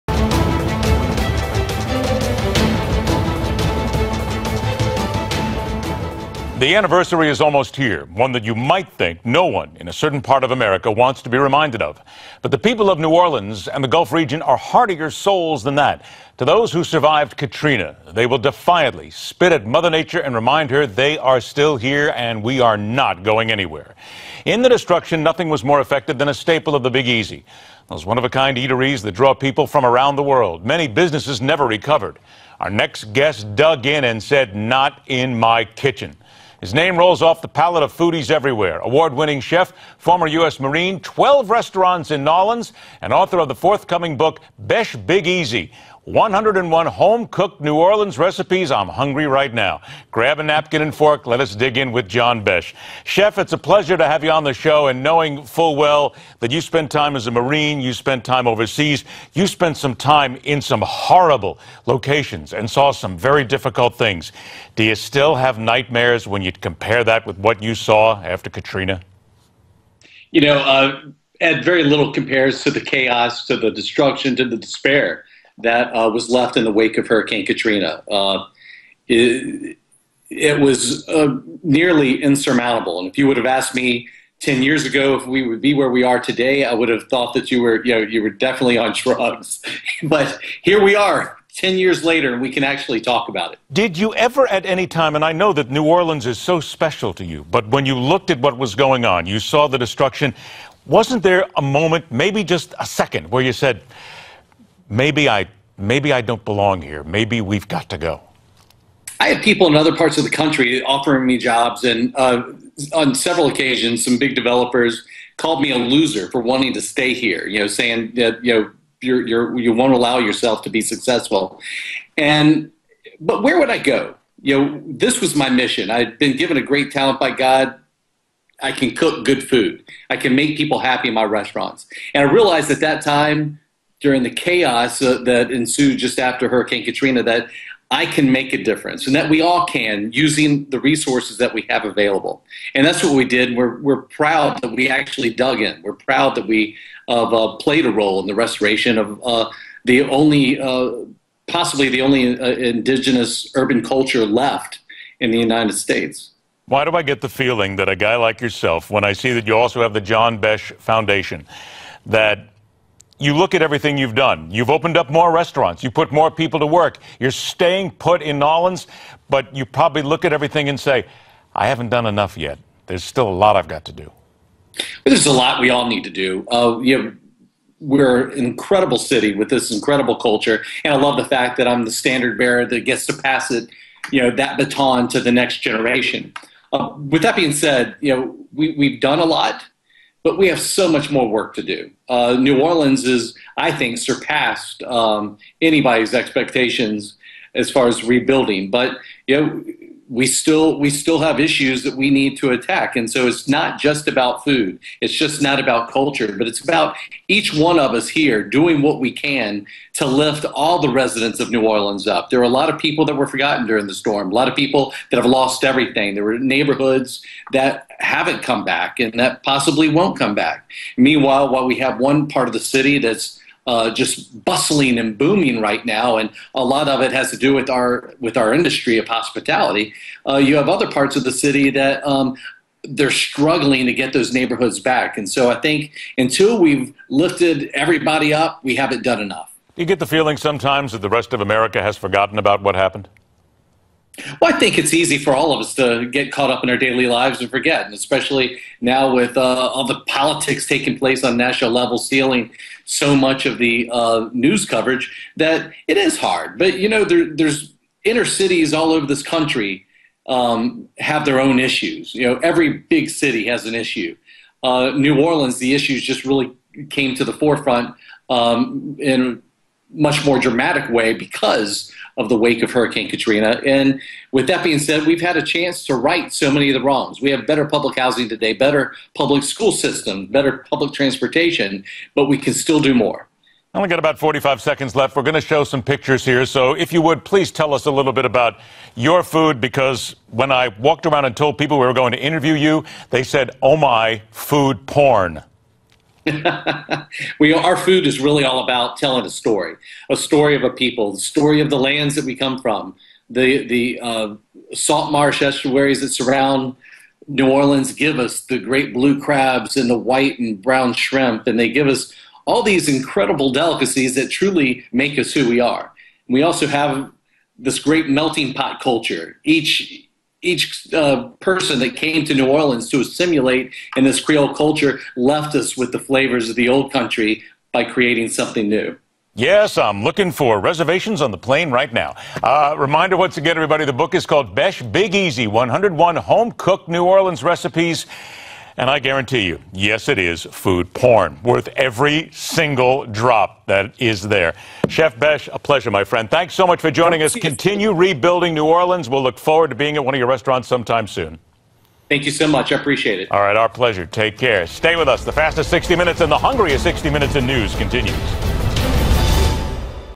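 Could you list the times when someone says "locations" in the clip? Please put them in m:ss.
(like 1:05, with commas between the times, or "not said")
1:01.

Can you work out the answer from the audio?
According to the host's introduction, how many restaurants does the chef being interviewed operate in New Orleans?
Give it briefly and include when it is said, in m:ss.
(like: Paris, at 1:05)
12, at 0:40.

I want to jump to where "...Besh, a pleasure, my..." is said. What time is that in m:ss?
5:45.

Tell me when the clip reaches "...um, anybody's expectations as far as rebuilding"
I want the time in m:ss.
3:14.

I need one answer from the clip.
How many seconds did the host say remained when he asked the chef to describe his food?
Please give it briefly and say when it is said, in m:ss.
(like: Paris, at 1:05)
45, at 4:44.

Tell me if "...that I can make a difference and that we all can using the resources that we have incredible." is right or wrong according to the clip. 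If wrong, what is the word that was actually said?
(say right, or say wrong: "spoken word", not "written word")
wrong: "available", not "incredible".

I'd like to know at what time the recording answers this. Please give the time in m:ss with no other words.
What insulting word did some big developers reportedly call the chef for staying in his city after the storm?
1:55.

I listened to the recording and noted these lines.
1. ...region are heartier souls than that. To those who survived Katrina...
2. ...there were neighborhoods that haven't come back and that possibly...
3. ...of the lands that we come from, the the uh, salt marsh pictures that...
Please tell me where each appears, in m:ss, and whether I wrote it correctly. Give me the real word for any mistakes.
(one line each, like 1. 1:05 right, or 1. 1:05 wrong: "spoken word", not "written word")
1. 0:14 right
2. 3:36 right
3. 5:01 wrong: "estuaries", not "pictures".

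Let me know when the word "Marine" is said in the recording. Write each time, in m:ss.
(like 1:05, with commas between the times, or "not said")
0:40, 0:57.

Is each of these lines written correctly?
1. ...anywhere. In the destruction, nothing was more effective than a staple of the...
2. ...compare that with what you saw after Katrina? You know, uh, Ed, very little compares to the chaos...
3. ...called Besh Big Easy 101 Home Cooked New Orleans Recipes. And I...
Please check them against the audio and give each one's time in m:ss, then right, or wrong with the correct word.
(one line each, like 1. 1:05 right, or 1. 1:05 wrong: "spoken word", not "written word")
1. 0:23 right
2. 1:06 right
3. 5:34 right.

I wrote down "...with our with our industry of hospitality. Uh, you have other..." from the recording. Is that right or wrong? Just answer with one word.
right.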